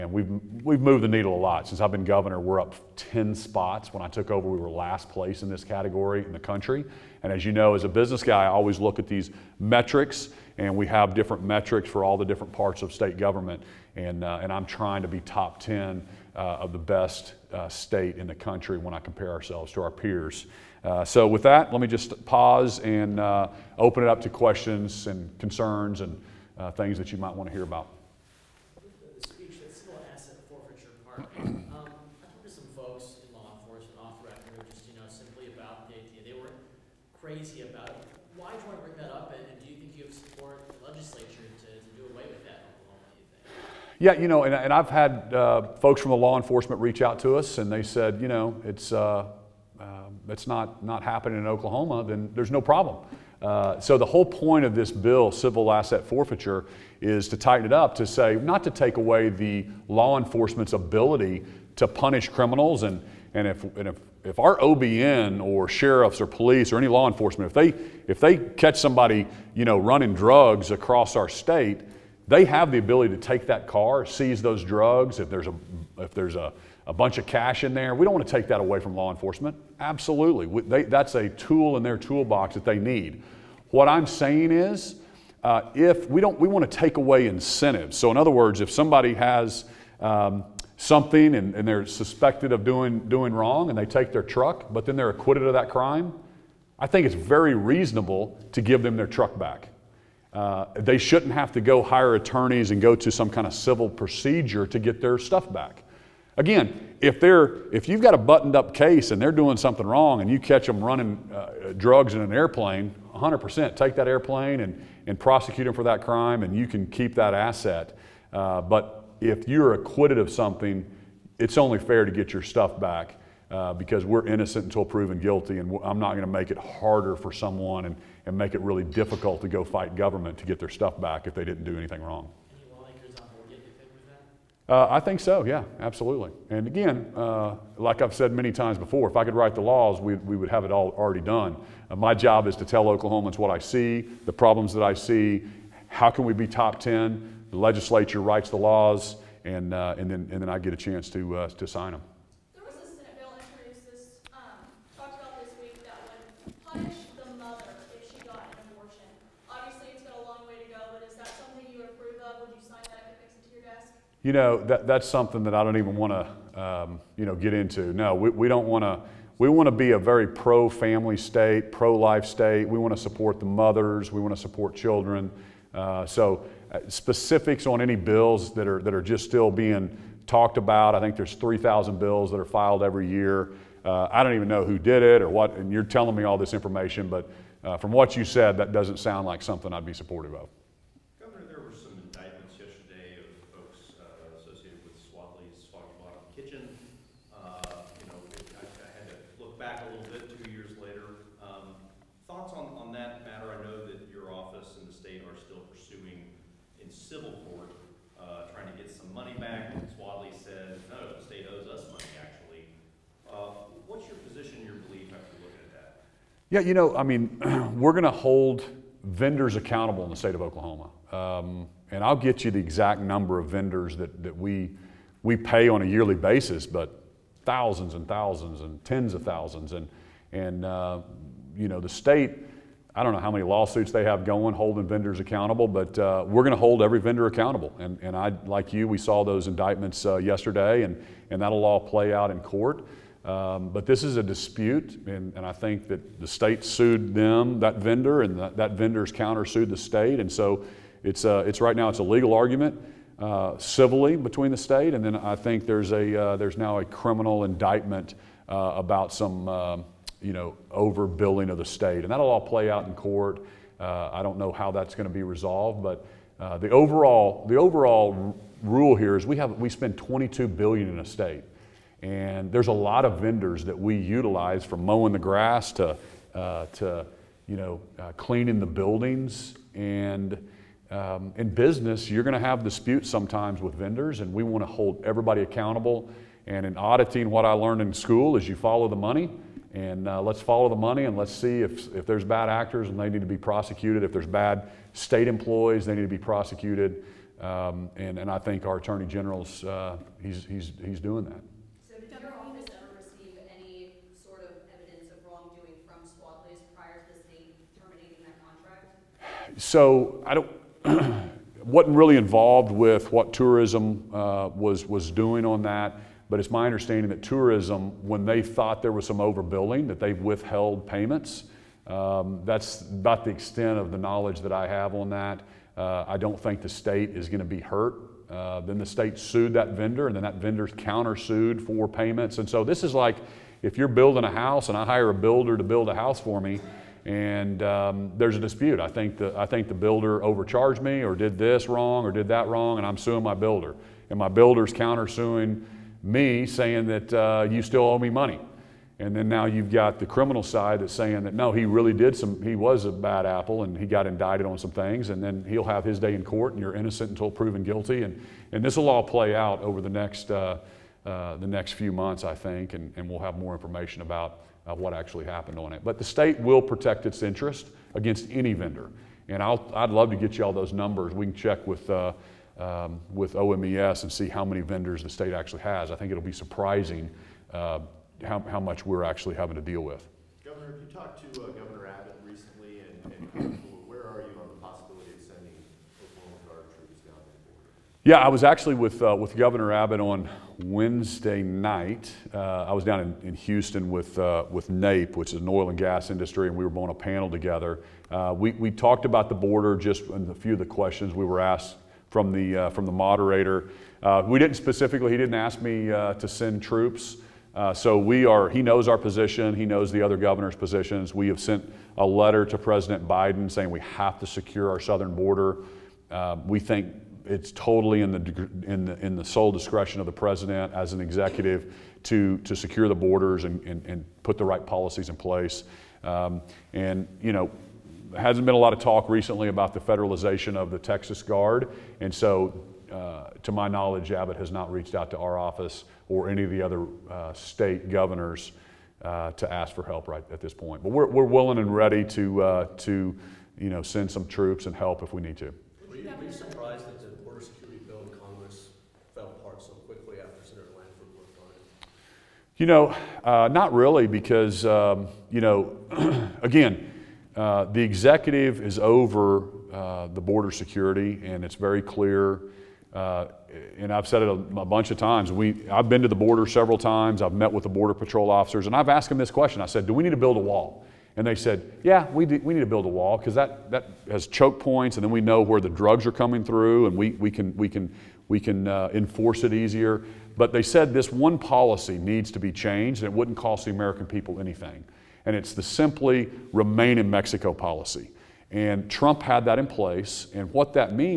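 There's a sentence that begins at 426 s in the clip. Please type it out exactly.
Um, and, you know, hasn't been a lot of talk recently about the federalization of the Texas Guard.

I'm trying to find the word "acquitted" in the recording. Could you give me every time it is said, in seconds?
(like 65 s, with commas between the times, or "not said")
95 s, 119 s.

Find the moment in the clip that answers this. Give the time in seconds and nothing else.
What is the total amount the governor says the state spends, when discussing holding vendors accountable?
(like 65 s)
269 s.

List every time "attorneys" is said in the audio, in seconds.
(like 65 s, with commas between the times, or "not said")
102 s, 298 s.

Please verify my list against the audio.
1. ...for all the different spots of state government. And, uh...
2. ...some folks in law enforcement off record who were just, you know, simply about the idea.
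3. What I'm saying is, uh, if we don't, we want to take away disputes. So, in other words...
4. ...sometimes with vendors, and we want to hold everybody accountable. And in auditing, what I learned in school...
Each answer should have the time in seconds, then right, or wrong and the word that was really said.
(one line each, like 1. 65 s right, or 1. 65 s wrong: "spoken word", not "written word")
1. 11 s wrong: "parts", not "spots"
2. 32 s right
3. 83 s wrong: "incentives", not "disputes"
4. 283 s right.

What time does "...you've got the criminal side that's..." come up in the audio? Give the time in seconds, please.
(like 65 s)
349 s.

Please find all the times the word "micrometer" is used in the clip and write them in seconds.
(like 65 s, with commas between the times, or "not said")
not said.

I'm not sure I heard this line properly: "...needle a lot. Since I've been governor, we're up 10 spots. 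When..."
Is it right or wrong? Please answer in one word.
right.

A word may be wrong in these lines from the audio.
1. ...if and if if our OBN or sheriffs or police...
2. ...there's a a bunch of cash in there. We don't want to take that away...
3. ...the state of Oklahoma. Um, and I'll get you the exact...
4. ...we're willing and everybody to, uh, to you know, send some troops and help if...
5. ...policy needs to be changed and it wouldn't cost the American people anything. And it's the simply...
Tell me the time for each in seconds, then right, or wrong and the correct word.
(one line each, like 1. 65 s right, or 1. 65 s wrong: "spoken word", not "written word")
1. 63 s right
2. 76 s right
3. 220 s right
4. 441 s wrong: "ready", not "everybody"
5. 481 s right.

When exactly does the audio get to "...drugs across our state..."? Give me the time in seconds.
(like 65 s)
70 s.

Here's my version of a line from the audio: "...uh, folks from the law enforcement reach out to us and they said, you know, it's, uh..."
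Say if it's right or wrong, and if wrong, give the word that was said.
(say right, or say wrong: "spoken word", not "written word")
right.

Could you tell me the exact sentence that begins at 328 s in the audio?
Uh, then the state sued that vendor, and then that vendor countersued for payments.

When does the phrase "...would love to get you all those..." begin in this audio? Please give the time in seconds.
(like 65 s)
369 s.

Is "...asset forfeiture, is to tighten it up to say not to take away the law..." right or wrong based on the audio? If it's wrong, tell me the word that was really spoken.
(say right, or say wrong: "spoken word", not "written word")
right.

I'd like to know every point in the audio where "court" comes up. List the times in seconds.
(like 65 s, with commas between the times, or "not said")
242 s, 262 s, 356 s.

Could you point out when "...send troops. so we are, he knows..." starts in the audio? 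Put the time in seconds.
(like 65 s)
406 s.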